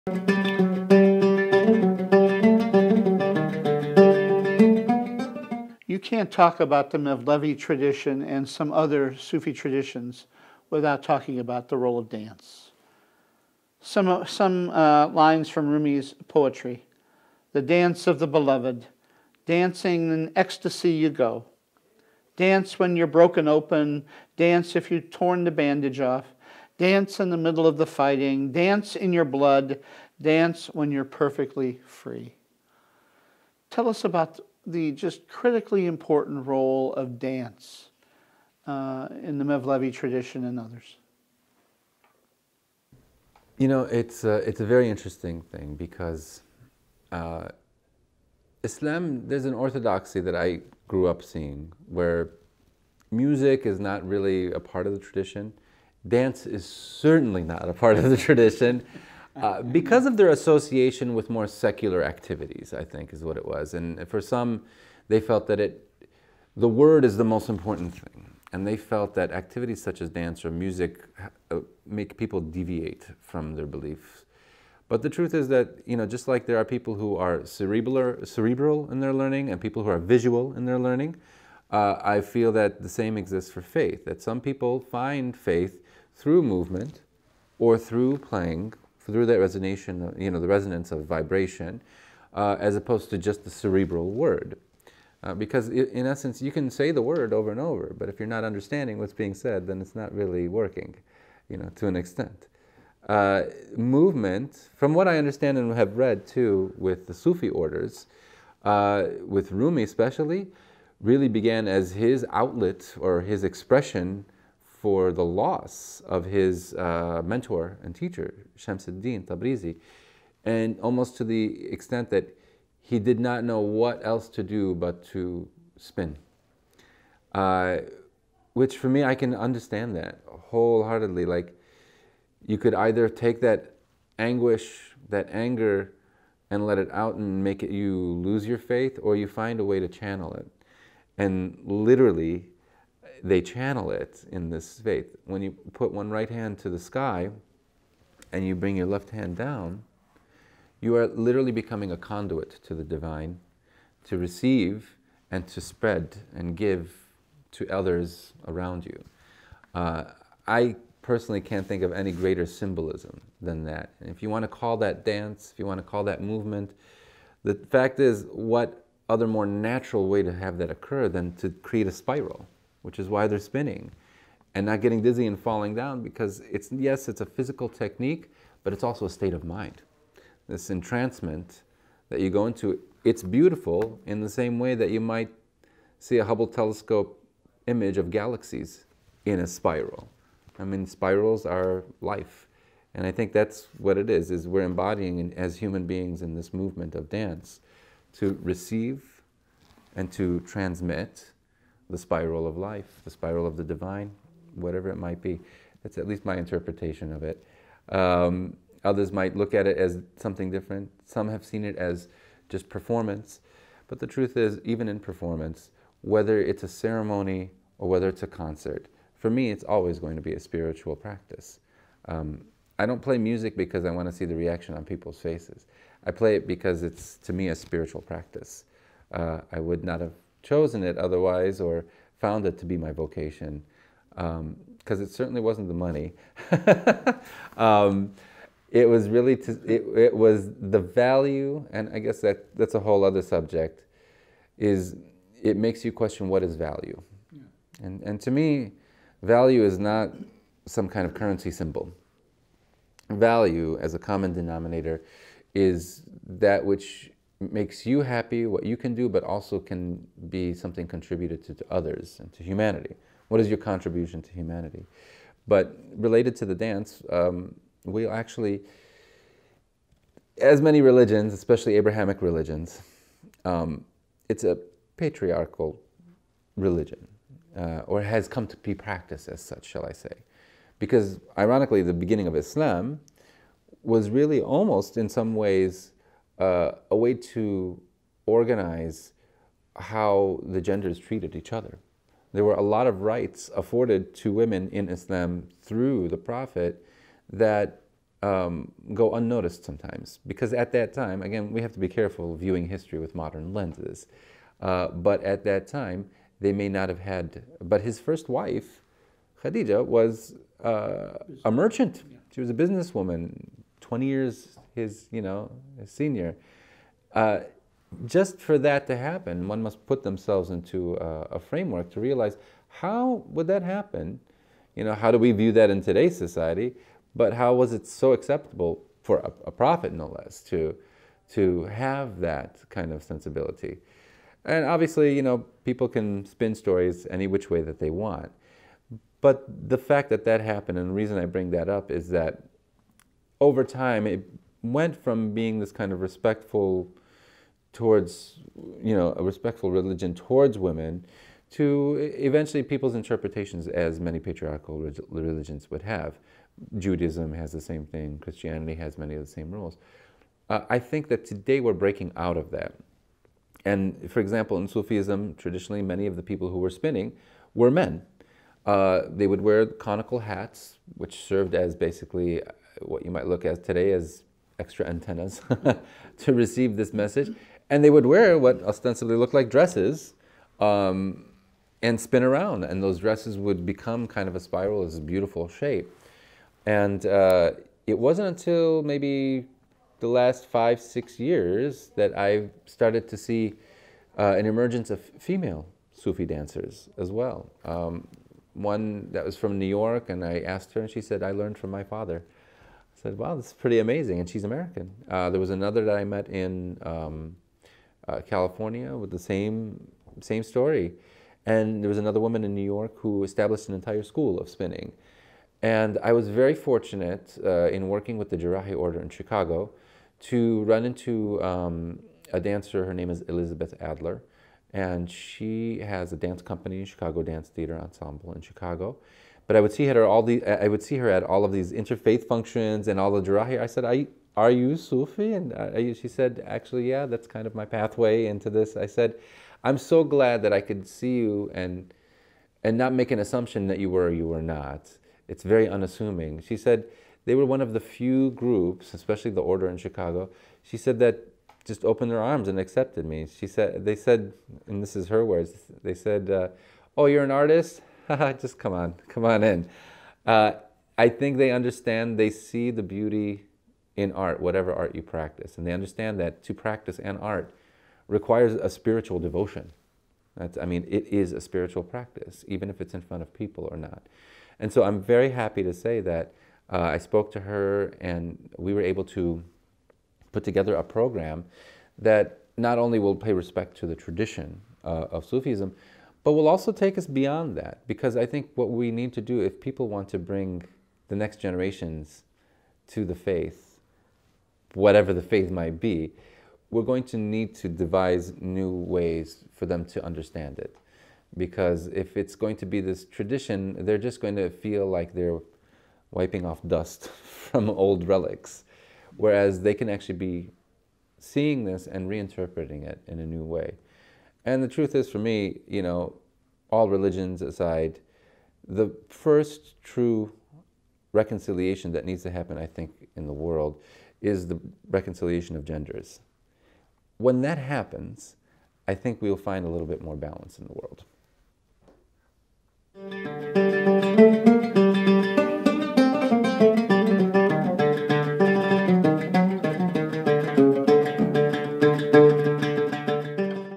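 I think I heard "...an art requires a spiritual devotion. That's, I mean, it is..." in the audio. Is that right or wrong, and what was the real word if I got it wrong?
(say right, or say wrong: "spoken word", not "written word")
right.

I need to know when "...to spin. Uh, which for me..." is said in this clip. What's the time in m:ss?
2:05.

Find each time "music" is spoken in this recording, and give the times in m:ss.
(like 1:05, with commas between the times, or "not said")
0:53, 1:10, 3:43.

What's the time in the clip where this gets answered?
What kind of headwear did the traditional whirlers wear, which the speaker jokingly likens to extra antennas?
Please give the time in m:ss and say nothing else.
6:09.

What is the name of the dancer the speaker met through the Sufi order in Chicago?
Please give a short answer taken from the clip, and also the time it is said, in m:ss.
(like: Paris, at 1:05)
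Ellyzabeth Adler, at 7:03.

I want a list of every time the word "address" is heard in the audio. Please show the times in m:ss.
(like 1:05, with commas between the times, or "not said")
not said.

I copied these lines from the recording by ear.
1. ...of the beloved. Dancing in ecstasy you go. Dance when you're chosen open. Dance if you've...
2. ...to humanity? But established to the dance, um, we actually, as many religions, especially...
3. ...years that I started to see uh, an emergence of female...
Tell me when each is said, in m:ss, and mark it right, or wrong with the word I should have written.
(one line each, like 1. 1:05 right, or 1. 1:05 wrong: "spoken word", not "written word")
1. 0:18 wrong: "broken", not "chosen"
2. 4:24 wrong: "related", not "established"
3. 6:31 right.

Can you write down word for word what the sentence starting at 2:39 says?
Uh, I personally can't think of any greater symbolism than that.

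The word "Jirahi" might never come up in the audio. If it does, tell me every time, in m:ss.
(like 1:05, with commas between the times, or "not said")
6:58, 7:13.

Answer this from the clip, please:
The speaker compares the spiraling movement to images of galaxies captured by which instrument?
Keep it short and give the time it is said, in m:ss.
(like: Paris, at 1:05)
Hubble telescope, at 3:06.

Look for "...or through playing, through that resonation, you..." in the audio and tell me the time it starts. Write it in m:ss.
1:27.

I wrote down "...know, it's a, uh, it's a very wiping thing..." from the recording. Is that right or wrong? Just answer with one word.
wrong.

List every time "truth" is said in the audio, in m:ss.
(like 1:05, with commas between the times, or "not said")
1:15, 3:34, 8:34.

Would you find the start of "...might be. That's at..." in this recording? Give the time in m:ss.
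3:24.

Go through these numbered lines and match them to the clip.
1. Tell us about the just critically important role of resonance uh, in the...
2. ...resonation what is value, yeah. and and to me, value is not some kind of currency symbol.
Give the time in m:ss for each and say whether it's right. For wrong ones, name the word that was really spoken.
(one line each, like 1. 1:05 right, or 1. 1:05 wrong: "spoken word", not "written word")
1. 0:33 wrong: "dance", not "resonance"
2. 4:05 wrong: "question", not "resonation".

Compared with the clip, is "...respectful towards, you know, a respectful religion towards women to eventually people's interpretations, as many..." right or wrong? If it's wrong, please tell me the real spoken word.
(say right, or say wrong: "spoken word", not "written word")
right.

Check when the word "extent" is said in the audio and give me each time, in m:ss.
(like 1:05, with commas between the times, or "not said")
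1:41, 2:01.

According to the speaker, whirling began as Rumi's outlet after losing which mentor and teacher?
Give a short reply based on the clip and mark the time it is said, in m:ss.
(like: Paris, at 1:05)
Shamsuddin Tabrizi, at 1:58.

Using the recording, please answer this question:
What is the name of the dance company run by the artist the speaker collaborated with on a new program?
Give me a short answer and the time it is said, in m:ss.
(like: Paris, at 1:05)
Chicago Danztheatre Ensemble, at 7:06.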